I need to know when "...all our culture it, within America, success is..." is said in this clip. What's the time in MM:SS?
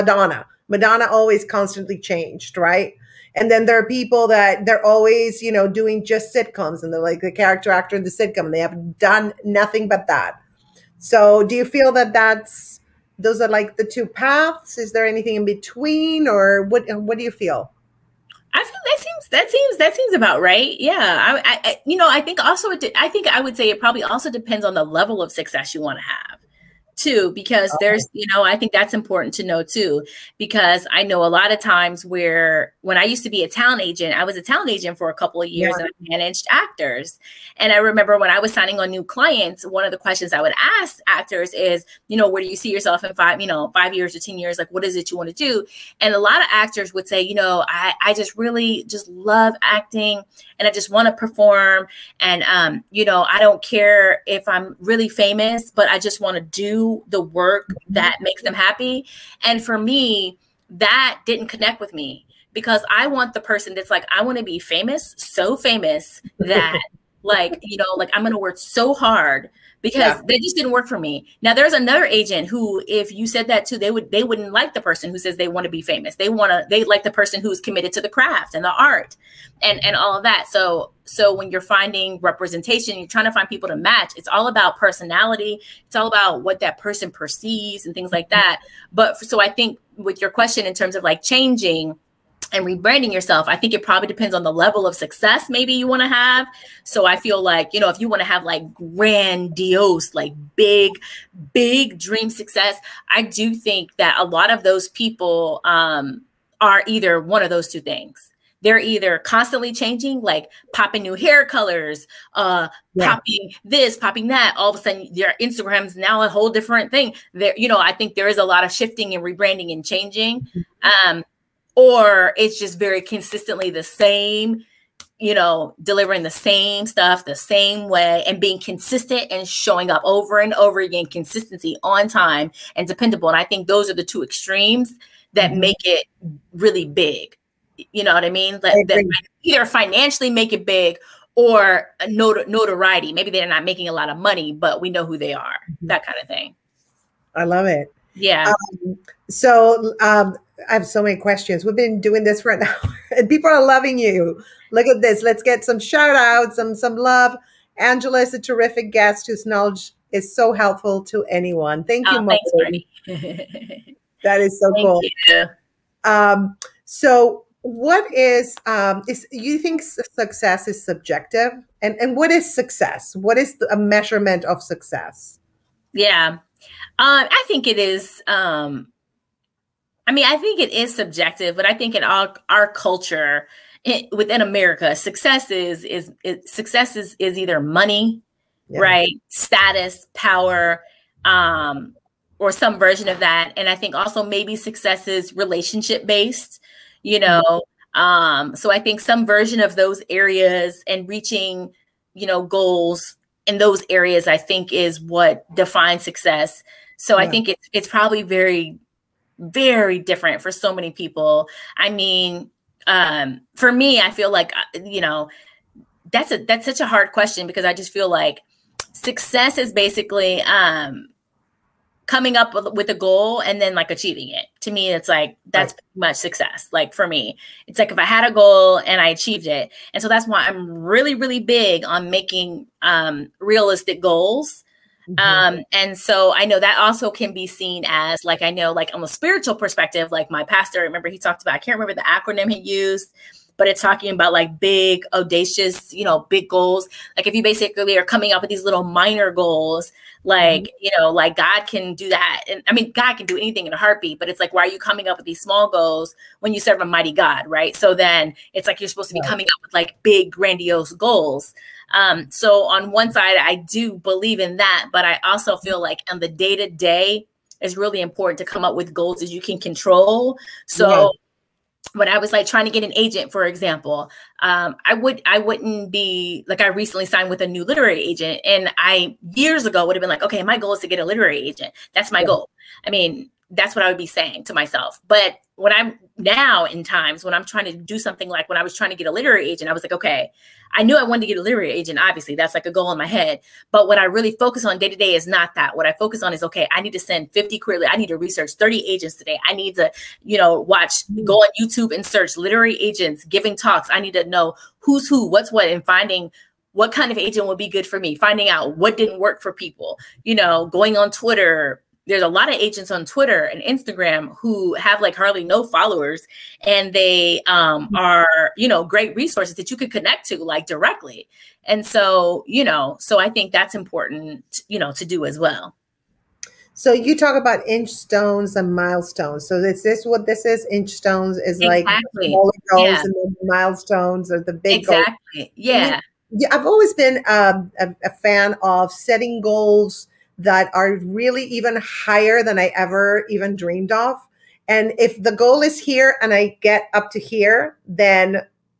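03:02.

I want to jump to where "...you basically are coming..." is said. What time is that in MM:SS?
04:07.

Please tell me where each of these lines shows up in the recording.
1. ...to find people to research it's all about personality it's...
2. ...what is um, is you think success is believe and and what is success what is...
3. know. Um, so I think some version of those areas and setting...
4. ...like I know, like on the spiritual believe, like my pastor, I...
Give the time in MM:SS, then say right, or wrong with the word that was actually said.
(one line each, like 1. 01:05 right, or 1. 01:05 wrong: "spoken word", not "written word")
1. 01:23 wrong: "match", not "research"
2. 02:47 wrong: "subjective", not "believe"
3. 03:17 wrong: "reaching", not "setting"
4. 03:58 wrong: "perspective", not "believe".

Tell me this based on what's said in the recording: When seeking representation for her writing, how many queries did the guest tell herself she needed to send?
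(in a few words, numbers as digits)
50.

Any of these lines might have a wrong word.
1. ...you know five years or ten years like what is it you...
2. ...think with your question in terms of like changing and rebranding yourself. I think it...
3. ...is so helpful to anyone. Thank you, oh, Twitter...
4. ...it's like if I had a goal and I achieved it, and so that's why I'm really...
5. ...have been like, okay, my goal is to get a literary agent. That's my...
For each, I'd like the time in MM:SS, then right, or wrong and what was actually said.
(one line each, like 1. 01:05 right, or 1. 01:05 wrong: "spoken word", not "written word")
1. 00:43 right
2. 01:29 right
3. 02:40 wrong: "Thanks", not "Twitter"
4. 03:47 right
5. 04:39 right.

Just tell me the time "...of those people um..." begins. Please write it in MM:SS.
01:44.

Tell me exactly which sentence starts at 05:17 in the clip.
are, you know, great resources that you could connect to like directly.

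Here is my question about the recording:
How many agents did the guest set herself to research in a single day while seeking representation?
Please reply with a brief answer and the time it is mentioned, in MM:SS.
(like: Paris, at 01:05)
30, at 04:58.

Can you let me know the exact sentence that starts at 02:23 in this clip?
Maybe they're not making a lot of money, but we know who they are, mm-hmm.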